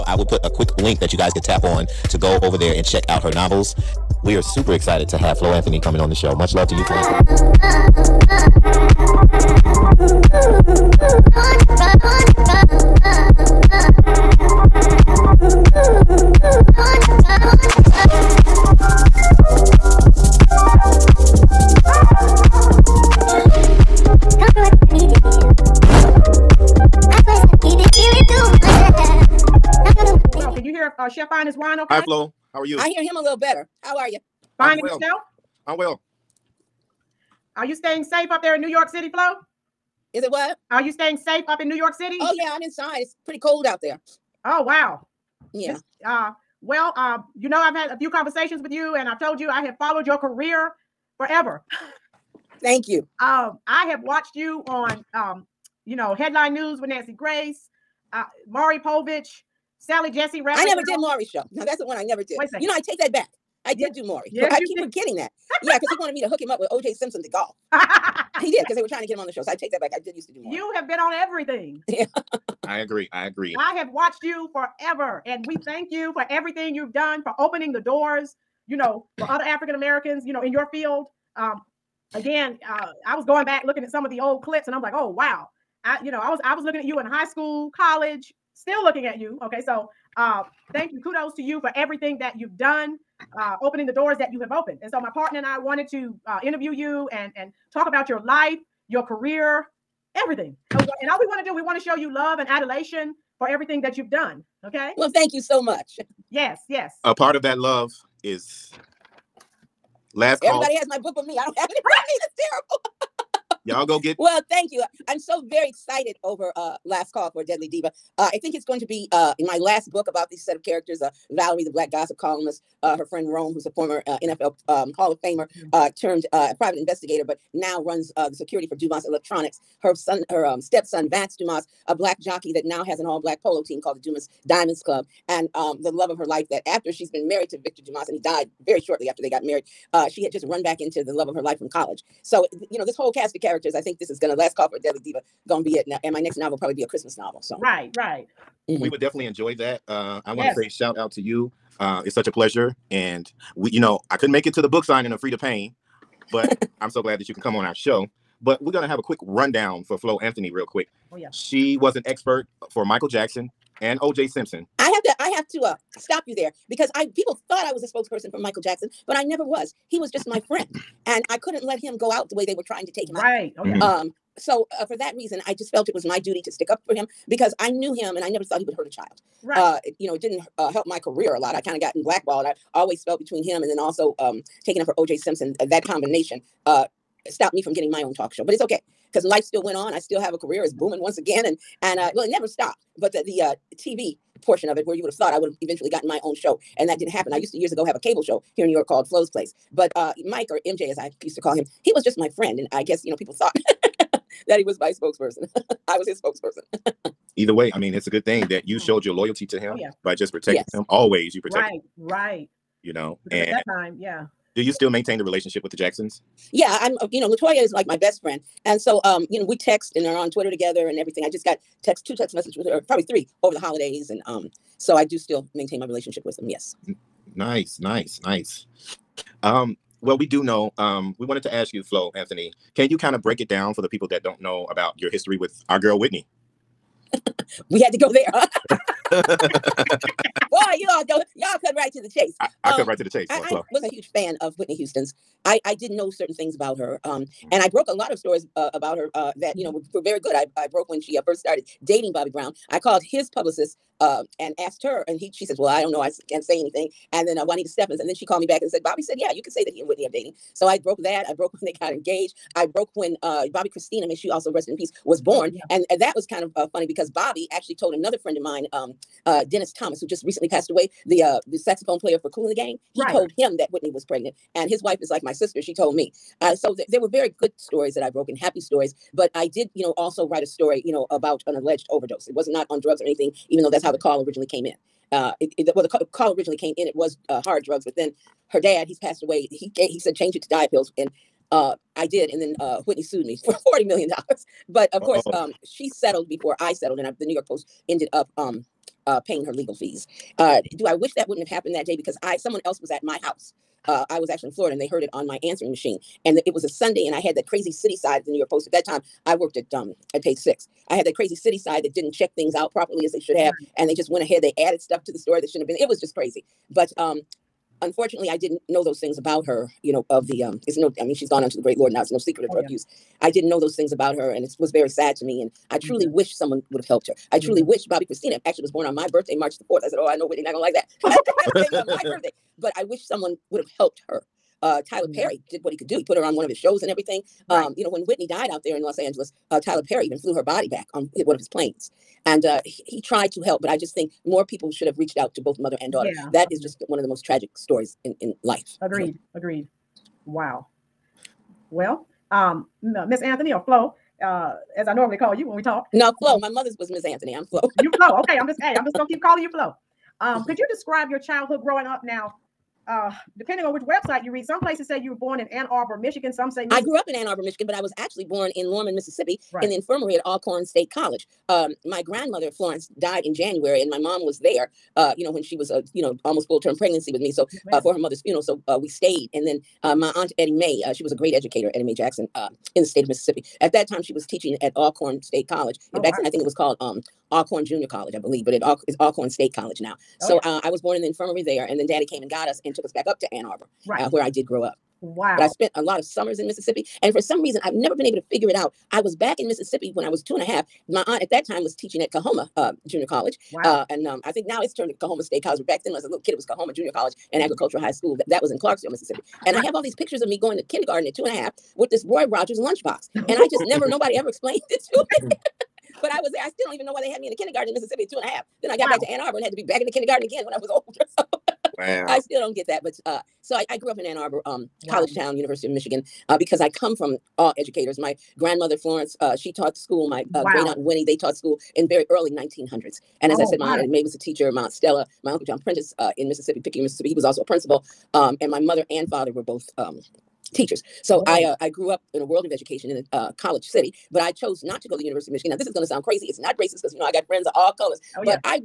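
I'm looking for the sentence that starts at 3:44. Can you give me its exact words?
And um, so I do still maintain my relationship with them.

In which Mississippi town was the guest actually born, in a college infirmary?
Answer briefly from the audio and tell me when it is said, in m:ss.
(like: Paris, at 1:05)
Lorman, at 6:08.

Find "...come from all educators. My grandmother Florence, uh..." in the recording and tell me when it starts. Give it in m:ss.
7:06.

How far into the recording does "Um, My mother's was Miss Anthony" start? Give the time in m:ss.
5:56.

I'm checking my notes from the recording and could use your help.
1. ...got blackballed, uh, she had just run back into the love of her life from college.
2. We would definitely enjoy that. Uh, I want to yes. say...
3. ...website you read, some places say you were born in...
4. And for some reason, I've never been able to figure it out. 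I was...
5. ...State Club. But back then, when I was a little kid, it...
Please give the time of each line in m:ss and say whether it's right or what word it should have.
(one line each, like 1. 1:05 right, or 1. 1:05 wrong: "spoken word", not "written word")
1. 2:19 wrong: "married", not "blackballed"
2. 2:28 right
3. 6:03 right
4. 6:37 right
5. 6:45 wrong: "College", not "Club".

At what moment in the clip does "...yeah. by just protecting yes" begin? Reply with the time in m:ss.
3:29.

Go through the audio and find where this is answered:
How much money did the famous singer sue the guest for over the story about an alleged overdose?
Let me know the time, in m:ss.
4:53.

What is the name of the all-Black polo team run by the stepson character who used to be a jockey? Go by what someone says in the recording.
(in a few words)
Dumas Diamonds Club.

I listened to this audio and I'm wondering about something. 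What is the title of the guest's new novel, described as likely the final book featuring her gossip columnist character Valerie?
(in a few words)
Last Call for Deadly Diva.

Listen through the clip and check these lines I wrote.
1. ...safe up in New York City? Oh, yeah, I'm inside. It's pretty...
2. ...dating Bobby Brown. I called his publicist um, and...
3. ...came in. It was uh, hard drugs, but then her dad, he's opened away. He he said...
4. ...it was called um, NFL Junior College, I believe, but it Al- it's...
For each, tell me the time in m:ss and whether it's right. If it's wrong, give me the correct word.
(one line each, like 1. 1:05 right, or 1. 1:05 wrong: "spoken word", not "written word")
1. 0:41 right
2. 4:11 right
3. 4:46 wrong: "passed", not "opened"
4. 6:26 wrong: "Alcorn", not "NFL".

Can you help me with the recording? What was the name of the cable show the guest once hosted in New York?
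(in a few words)
Flo's Place.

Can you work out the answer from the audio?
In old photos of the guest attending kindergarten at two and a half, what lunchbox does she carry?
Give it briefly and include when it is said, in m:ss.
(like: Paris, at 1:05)
Roy Rogers lunchbox, at 6:52.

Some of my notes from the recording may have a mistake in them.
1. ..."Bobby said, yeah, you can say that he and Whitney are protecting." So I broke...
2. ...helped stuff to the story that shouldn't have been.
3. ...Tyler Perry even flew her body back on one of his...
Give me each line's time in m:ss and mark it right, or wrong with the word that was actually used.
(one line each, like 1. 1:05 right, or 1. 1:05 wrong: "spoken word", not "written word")
1. 4:18 wrong: "dating", not "protecting"
2. 5:14 wrong: "added", not "helped"
3. 5:39 right.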